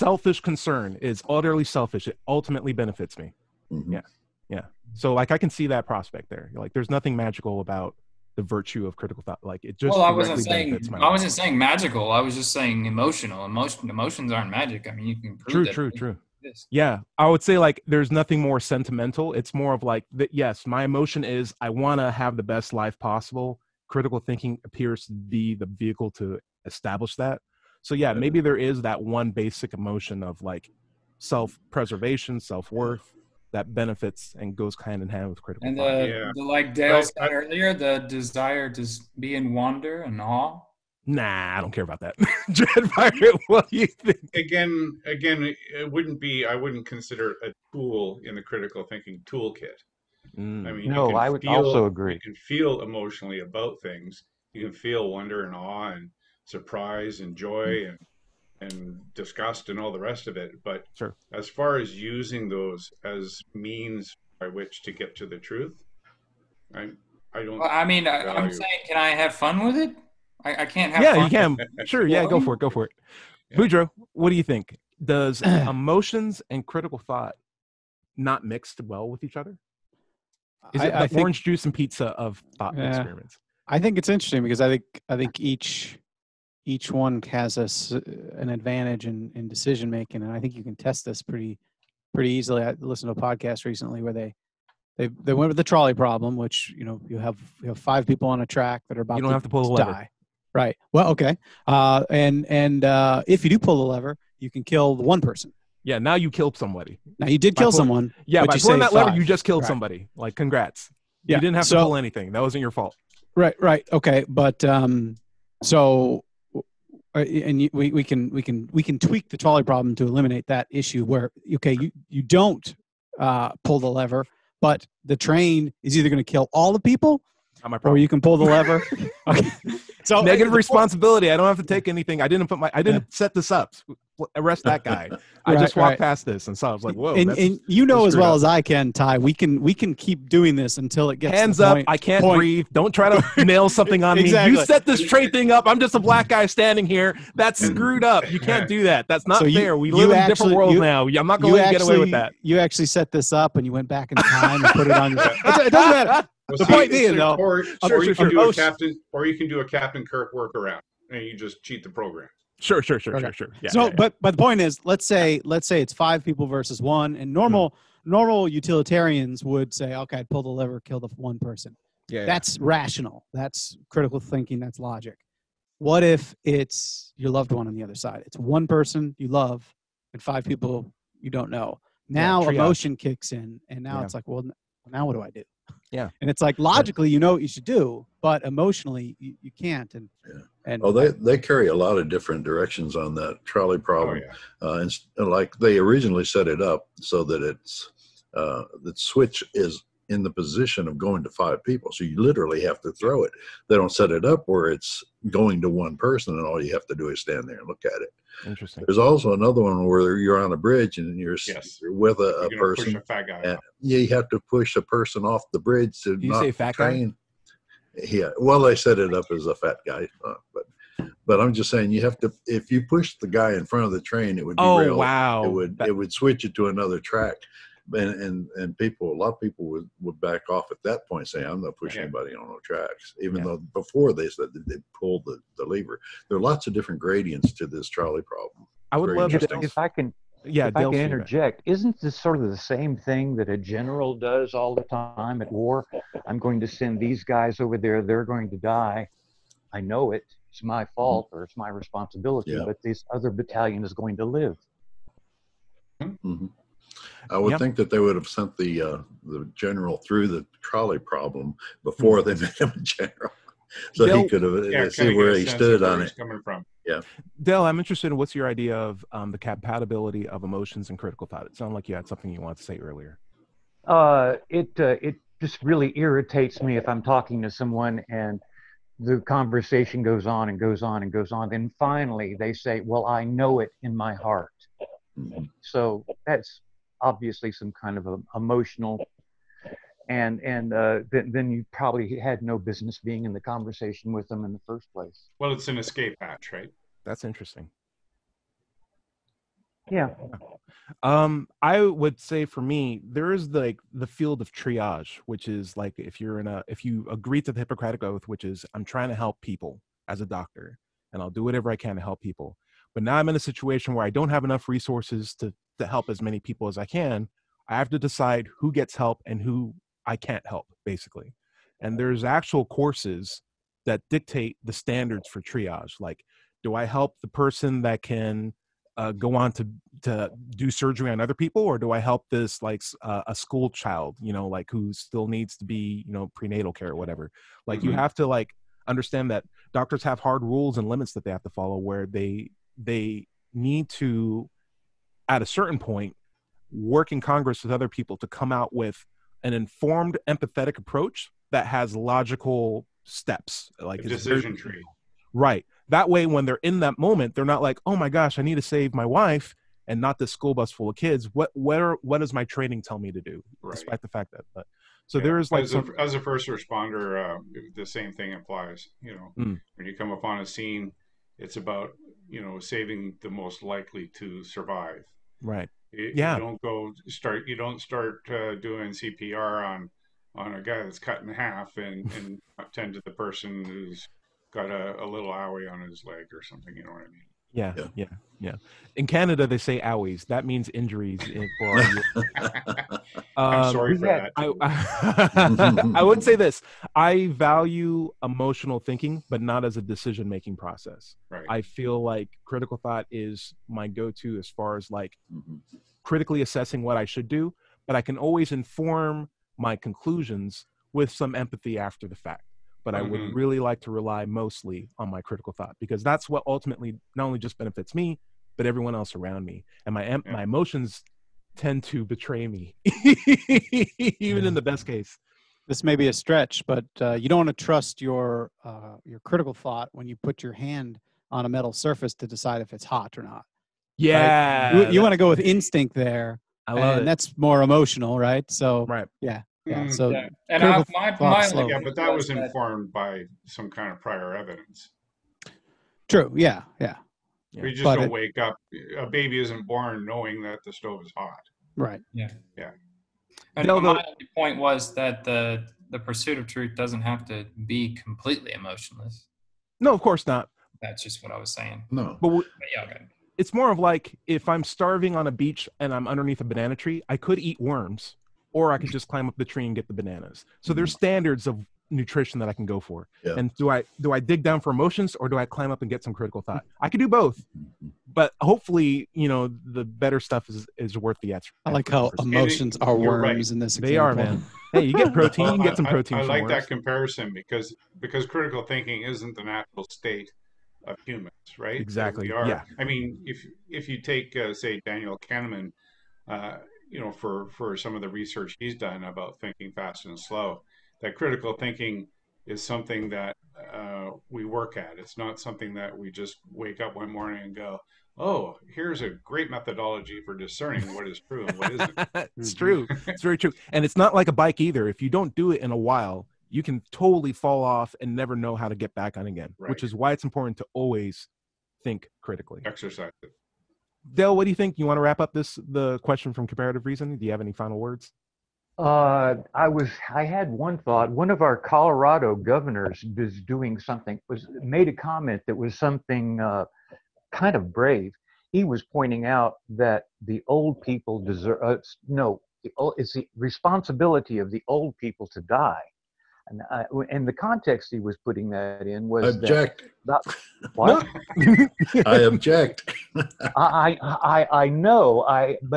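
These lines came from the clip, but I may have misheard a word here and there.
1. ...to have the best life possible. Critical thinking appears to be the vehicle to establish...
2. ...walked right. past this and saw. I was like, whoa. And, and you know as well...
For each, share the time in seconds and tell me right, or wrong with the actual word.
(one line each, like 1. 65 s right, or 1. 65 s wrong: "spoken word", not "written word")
1. 22 s right
2. 135 s right.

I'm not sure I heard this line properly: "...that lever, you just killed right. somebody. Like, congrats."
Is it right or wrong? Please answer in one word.
right.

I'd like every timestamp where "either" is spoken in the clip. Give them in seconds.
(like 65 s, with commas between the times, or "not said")
125 s, 514 s.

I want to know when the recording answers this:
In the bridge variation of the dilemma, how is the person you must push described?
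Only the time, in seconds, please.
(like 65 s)
219 s.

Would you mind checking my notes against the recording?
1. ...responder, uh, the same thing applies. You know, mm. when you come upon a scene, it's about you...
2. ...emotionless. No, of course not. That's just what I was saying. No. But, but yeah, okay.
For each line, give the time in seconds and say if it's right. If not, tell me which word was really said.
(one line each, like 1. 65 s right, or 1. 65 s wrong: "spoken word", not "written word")
1. 366 s right
2. 458 s right.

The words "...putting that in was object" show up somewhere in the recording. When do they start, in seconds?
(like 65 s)
548 s.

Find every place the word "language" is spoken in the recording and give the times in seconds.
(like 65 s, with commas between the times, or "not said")
not said.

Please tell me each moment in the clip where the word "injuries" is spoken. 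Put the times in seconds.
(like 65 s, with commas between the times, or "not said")
390 s.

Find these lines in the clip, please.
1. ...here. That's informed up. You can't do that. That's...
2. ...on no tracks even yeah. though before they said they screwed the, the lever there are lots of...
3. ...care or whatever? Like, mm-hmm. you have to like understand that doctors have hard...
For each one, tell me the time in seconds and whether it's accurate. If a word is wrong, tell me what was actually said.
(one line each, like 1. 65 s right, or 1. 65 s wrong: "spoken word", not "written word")
1. 146 s wrong: "screwed", not "informed"
2. 232 s wrong: "pulled", not "screwed"
3. 336 s right.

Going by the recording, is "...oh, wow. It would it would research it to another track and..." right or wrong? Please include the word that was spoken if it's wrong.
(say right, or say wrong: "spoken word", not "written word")
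wrong: "switch", not "research".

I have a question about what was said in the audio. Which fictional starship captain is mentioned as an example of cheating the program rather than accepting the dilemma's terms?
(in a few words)
Captain Kirk.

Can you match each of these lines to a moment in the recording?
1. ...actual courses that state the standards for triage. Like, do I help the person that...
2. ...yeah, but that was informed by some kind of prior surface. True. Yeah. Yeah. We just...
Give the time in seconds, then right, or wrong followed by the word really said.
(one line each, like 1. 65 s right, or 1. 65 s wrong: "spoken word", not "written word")
1. 322 s wrong: "dictate", not "state"
2. 441 s wrong: "evidence", not "surface".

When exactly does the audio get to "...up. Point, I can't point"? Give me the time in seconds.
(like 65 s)
141 s.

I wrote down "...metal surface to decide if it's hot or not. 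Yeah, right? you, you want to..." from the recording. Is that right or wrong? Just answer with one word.
right.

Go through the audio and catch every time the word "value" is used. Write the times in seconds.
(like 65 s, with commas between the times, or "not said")
68 s, 397 s.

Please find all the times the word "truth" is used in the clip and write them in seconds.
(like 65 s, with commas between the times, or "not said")
65 s, 456 s.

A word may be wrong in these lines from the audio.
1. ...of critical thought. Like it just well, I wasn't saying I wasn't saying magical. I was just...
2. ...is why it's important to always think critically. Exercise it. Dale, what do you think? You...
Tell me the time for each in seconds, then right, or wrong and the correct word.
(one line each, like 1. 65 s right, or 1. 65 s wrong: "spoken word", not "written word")
1. 8 s right
2. 519 s right.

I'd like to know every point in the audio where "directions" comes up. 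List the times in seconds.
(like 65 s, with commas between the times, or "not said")
192 s.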